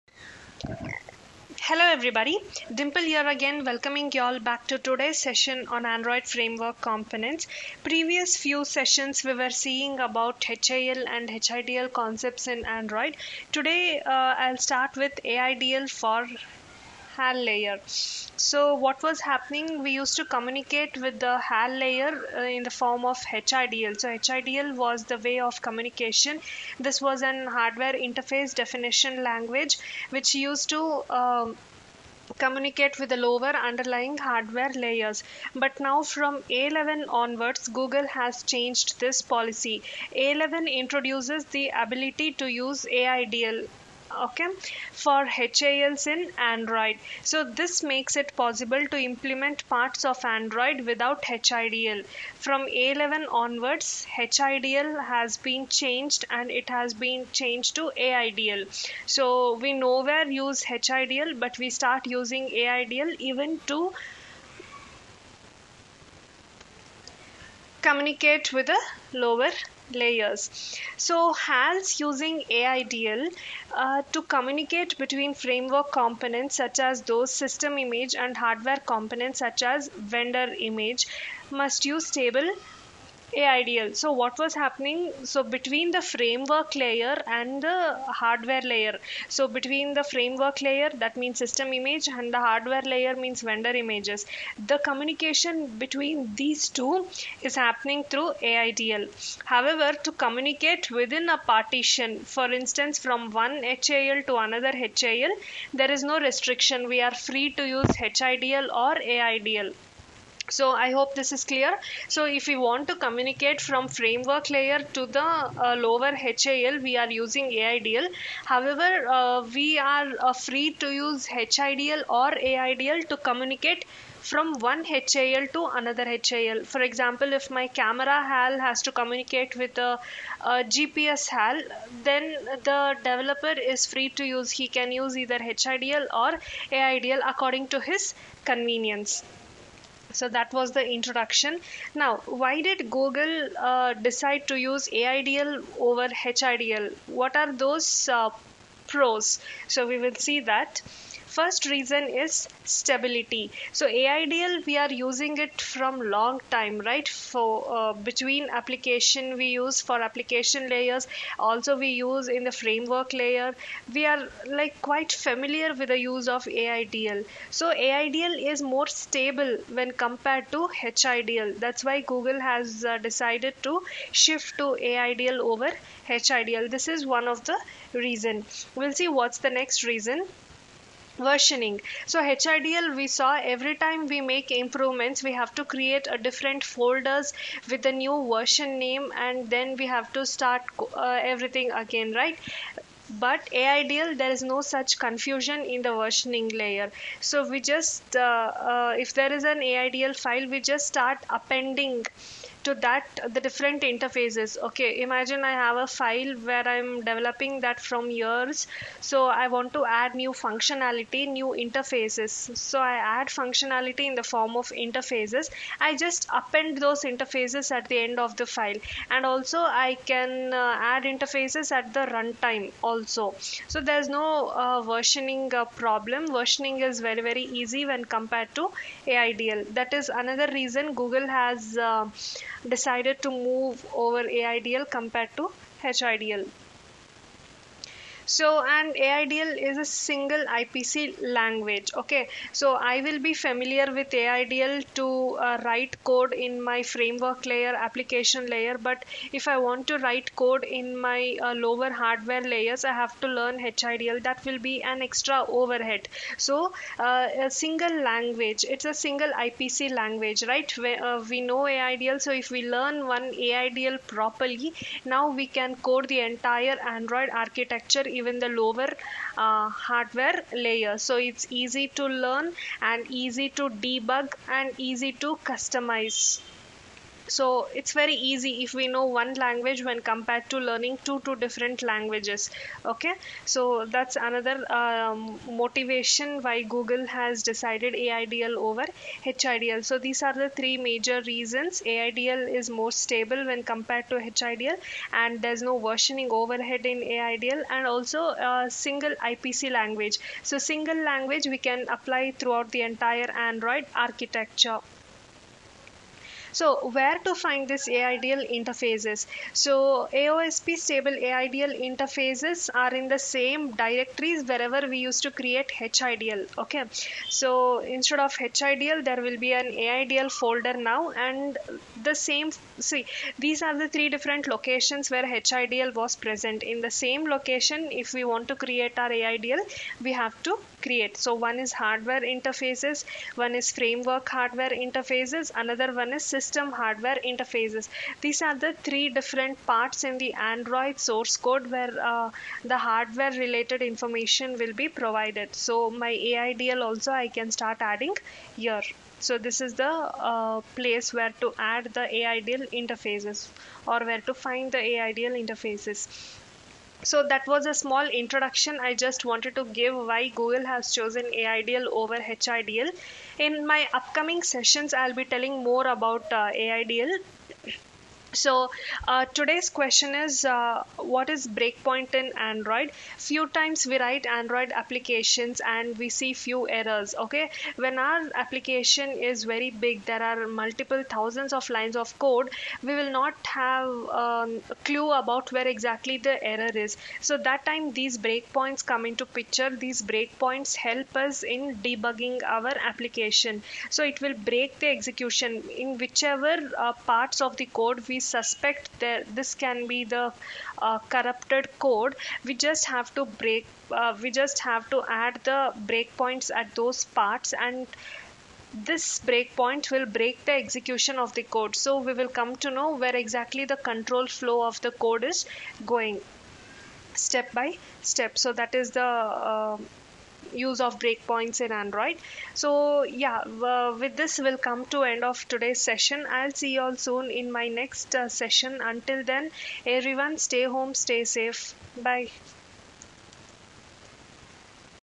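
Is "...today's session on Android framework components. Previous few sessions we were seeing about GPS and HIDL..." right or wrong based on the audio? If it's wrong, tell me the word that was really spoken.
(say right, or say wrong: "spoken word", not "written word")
wrong: "HAL", not "GPS".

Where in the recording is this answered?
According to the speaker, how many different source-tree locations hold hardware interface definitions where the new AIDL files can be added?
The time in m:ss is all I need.
5:23.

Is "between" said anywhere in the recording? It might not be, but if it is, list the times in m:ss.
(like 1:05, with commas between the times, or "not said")
1:14, 1:25, 1:29, 1:35, 2:38.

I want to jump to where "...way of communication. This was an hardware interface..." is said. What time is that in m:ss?
0:25.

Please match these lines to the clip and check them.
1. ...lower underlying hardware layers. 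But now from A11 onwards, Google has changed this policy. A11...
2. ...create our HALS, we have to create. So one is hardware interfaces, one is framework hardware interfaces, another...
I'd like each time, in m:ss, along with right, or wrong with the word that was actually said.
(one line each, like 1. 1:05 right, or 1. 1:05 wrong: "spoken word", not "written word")
1. 0:33 right
2. 5:28 wrong: "AIDL", not "HALS".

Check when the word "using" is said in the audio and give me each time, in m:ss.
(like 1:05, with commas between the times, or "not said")
1:02, 1:11, 1:57, 2:34.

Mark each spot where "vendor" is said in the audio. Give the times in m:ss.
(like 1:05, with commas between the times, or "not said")
1:20, 1:33.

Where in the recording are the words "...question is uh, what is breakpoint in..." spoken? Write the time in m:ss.
6:09.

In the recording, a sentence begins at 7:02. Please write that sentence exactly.
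So yeah, uh, with this we'll come to end of today's session.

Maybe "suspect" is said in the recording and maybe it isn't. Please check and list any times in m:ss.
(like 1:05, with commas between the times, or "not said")
6:38.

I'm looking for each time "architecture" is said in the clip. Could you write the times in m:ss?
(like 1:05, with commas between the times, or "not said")
4:27, 5:03.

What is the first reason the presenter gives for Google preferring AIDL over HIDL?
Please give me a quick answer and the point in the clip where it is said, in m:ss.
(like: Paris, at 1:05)
Stability, at 2:32.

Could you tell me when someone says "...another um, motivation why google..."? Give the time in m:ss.
4:44.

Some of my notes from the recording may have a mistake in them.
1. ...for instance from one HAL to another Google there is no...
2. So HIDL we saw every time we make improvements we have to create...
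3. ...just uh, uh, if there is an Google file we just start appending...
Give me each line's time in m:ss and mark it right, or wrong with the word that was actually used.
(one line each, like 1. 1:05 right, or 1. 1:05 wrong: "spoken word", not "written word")
1. 1:42 wrong: "HAL", not "Google"
2. 3:02 right
3. 3:17 wrong: "AIDL", not "Google".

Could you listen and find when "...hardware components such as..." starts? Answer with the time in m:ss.
1:18.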